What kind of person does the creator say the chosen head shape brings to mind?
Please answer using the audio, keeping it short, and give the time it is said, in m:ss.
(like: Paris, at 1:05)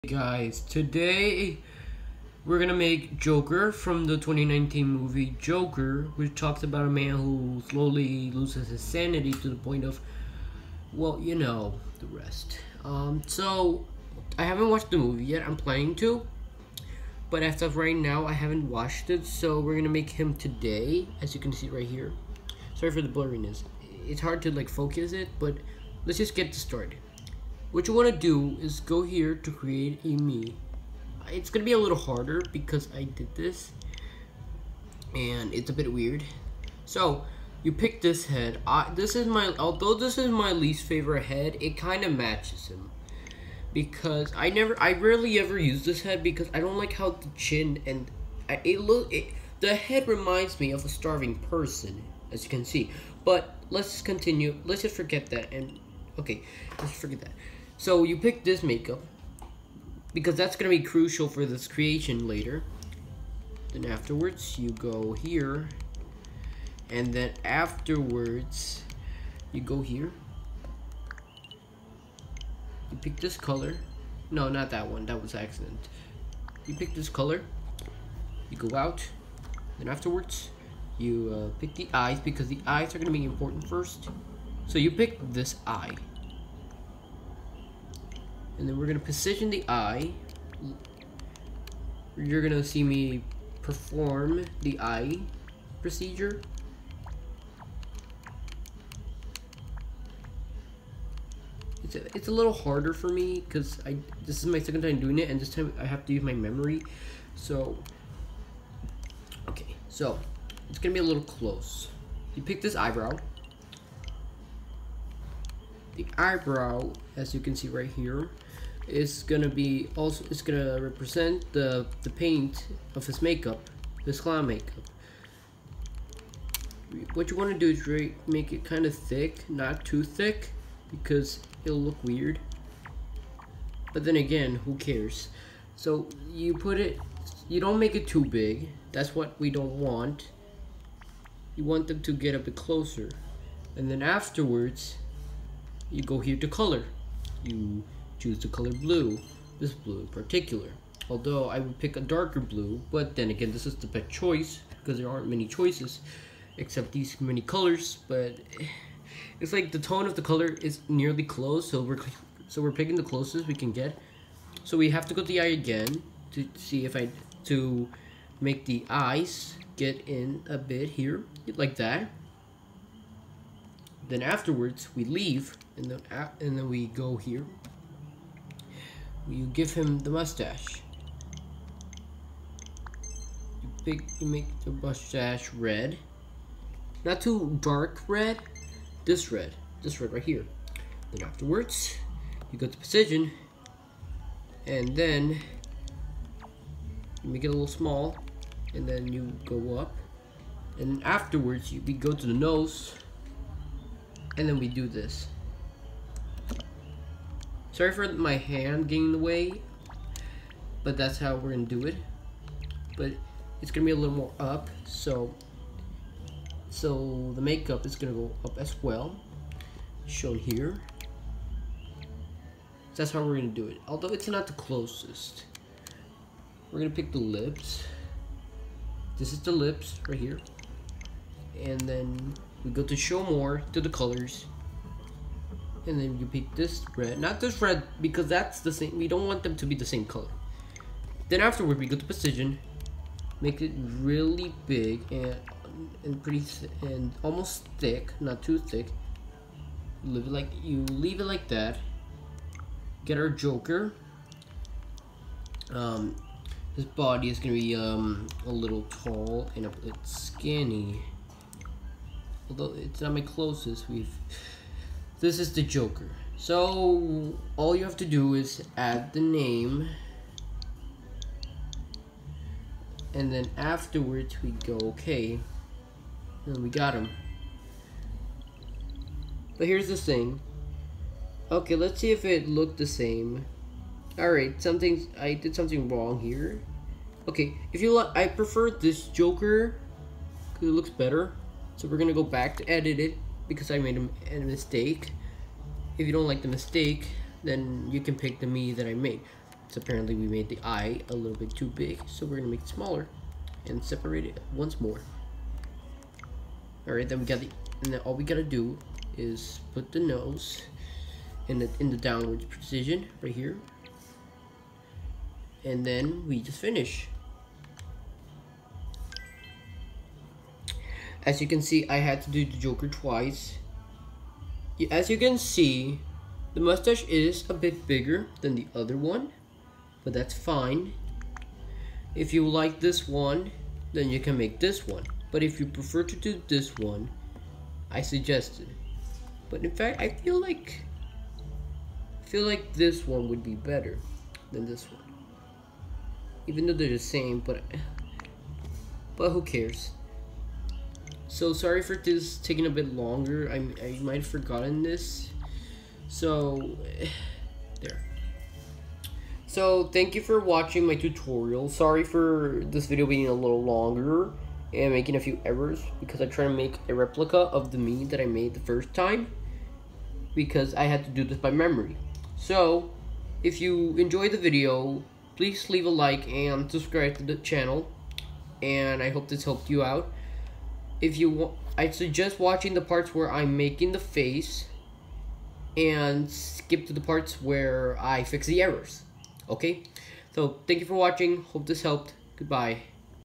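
A starving person, at 0:50.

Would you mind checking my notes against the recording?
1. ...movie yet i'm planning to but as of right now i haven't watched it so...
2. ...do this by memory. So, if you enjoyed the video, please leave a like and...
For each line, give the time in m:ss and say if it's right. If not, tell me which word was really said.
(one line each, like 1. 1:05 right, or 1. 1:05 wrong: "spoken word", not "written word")
1. 0:14 right
2. 6:11 right.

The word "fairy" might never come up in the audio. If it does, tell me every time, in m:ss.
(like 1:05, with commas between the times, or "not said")
not said.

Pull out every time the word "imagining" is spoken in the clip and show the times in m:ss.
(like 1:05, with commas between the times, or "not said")
not said.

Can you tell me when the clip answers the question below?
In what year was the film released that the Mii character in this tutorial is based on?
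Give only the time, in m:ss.
0:04.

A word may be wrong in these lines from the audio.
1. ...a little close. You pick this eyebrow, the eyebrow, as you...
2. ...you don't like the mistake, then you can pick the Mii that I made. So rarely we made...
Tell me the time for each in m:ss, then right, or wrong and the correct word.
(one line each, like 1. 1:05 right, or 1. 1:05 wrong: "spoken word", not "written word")
1. 1:50 right
2. 4:56 wrong: "apparently", not "rarely".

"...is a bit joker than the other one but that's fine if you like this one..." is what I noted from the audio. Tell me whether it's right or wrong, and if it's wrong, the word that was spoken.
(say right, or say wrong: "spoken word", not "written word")
wrong: "bigger", not "joker".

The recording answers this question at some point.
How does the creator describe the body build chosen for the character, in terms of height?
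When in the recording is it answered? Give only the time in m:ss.
4:18.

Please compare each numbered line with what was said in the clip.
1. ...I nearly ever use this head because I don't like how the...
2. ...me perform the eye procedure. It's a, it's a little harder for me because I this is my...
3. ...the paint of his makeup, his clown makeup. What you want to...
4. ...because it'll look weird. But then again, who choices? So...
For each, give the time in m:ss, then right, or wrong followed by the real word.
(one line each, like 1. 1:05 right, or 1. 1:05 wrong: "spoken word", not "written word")
1. 0:44 wrong: "rarely", not "nearly"
2. 1:32 right
3. 2:02 right
4. 2:10 wrong: "cares", not "choices".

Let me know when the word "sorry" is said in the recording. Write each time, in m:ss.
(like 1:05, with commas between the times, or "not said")
0:22, 3:27, 5:51, 6:01.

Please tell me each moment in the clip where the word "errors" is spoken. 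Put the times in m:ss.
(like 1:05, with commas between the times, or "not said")
6:05, 6:28.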